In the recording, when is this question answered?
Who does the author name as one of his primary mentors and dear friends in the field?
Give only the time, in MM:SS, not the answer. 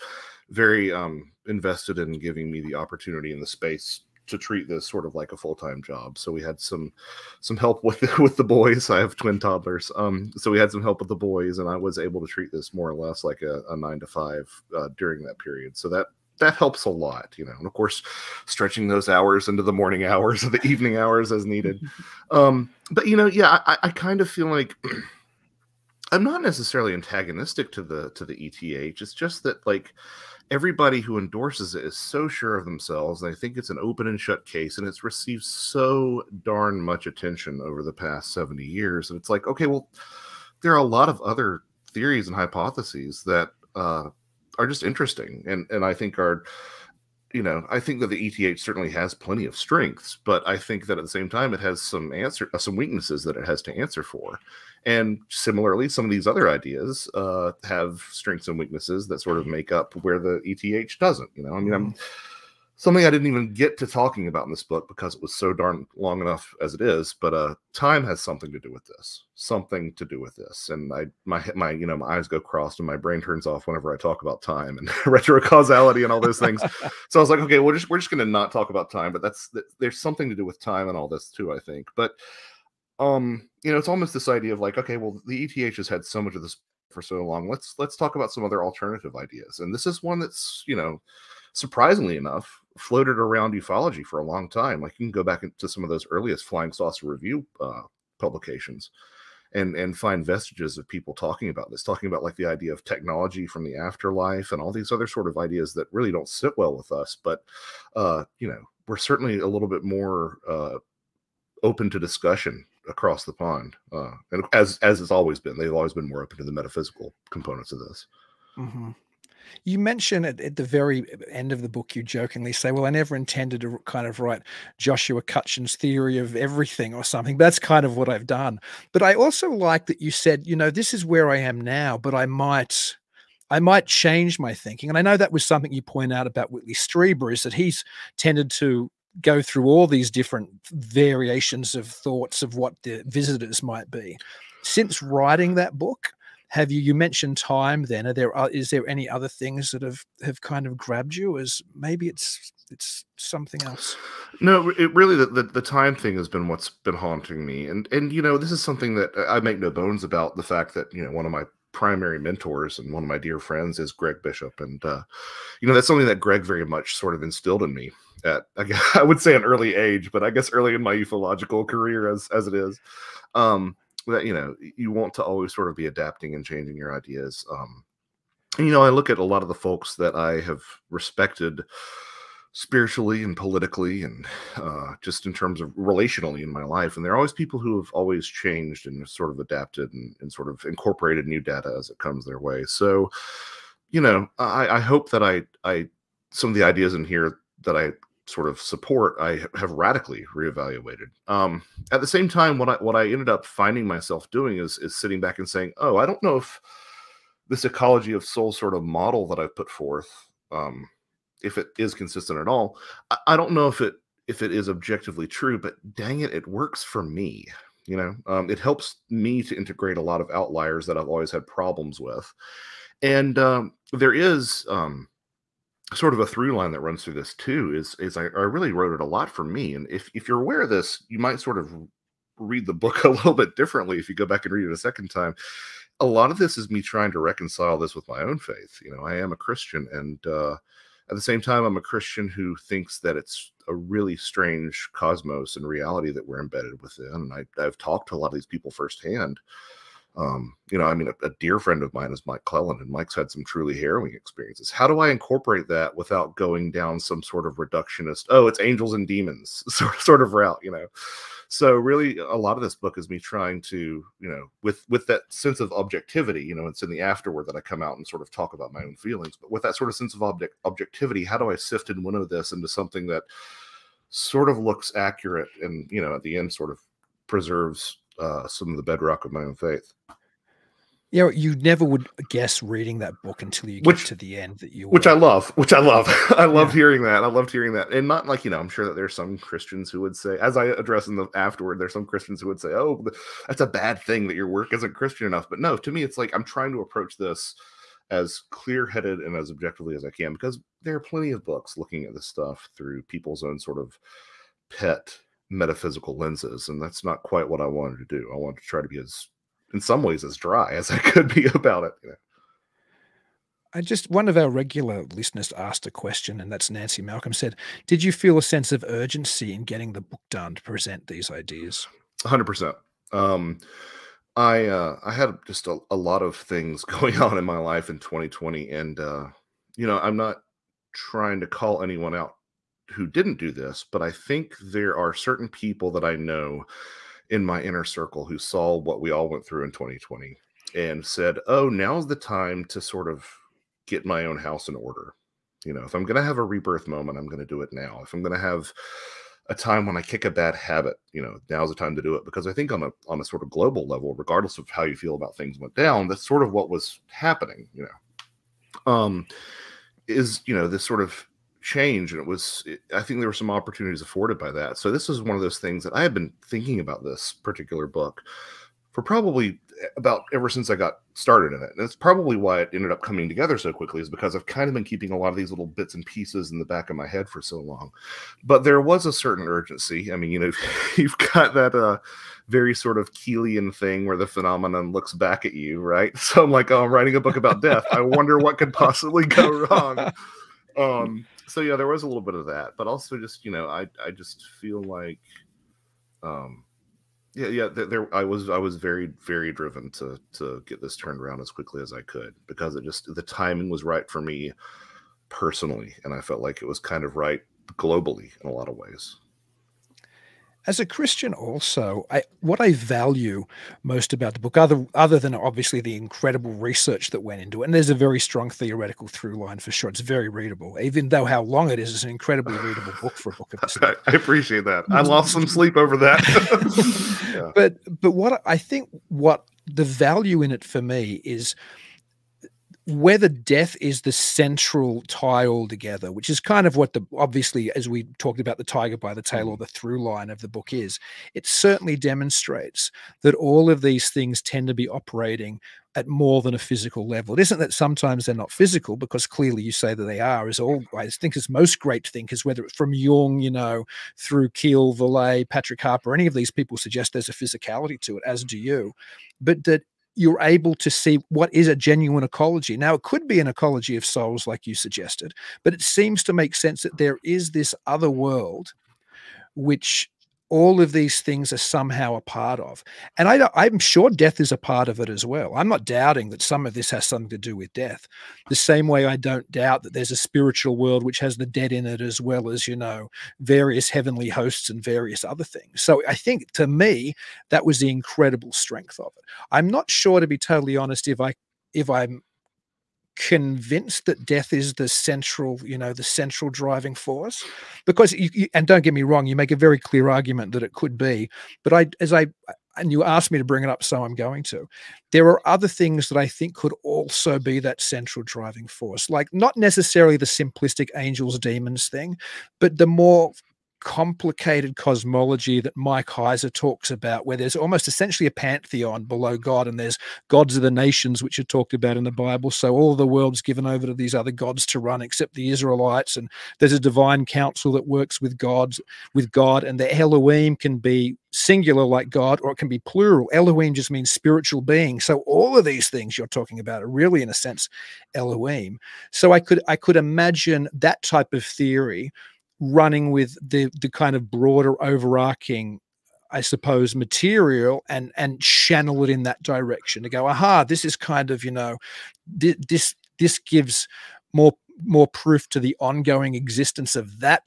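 02:43.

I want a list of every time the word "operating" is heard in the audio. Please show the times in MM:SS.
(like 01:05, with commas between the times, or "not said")
07:24.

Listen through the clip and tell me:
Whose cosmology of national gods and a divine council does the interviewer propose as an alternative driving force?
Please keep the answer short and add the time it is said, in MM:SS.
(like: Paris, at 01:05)
Mike Heiser, at 08:35.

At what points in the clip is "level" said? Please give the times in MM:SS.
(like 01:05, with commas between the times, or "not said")
05:53, 07:27.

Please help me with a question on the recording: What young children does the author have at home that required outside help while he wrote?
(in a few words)
Twin toddlers.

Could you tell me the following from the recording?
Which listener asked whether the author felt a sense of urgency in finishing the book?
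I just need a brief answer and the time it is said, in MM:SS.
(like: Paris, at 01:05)
Nancy Malcolm, at 05:16.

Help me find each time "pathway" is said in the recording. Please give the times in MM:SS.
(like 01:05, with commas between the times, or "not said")
not said.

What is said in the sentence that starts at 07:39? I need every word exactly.
But that you're able to see what is a genuine ecology.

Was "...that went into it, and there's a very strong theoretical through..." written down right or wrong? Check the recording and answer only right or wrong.
right.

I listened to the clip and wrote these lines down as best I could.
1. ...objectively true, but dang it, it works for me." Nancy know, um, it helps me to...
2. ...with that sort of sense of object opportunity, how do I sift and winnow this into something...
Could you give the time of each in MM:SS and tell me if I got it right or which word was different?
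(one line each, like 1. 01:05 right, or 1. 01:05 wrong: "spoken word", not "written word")
1. 03:34 wrong: "You", not "Nancy"
2. 04:29 wrong: "objectivity", not "opportunity".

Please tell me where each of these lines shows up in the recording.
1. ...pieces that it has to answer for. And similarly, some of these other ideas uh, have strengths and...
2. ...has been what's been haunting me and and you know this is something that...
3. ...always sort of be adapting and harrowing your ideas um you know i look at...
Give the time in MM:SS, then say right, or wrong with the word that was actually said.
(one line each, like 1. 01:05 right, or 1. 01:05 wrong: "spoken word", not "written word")
1. 00:52 wrong: "weaknesses", not "pieces"
2. 02:36 right
3. 02:55 wrong: "changing", not "harrowing".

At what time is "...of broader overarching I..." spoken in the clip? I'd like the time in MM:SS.
09:04.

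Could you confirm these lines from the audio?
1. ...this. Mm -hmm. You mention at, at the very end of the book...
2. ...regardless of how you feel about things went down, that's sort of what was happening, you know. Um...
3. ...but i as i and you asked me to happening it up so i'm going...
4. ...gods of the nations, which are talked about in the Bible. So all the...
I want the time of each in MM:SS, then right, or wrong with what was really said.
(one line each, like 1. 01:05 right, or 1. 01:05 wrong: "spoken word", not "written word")
1. 01:57 right
2. 05:54 right
3. 08:21 wrong: "bring", not "happening"
4. 08:40 right.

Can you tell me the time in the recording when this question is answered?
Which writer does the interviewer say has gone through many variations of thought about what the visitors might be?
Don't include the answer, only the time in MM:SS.
02:16.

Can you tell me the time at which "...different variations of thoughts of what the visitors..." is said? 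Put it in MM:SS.
02:20.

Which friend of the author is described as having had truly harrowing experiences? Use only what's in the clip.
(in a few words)
Mike Clelland.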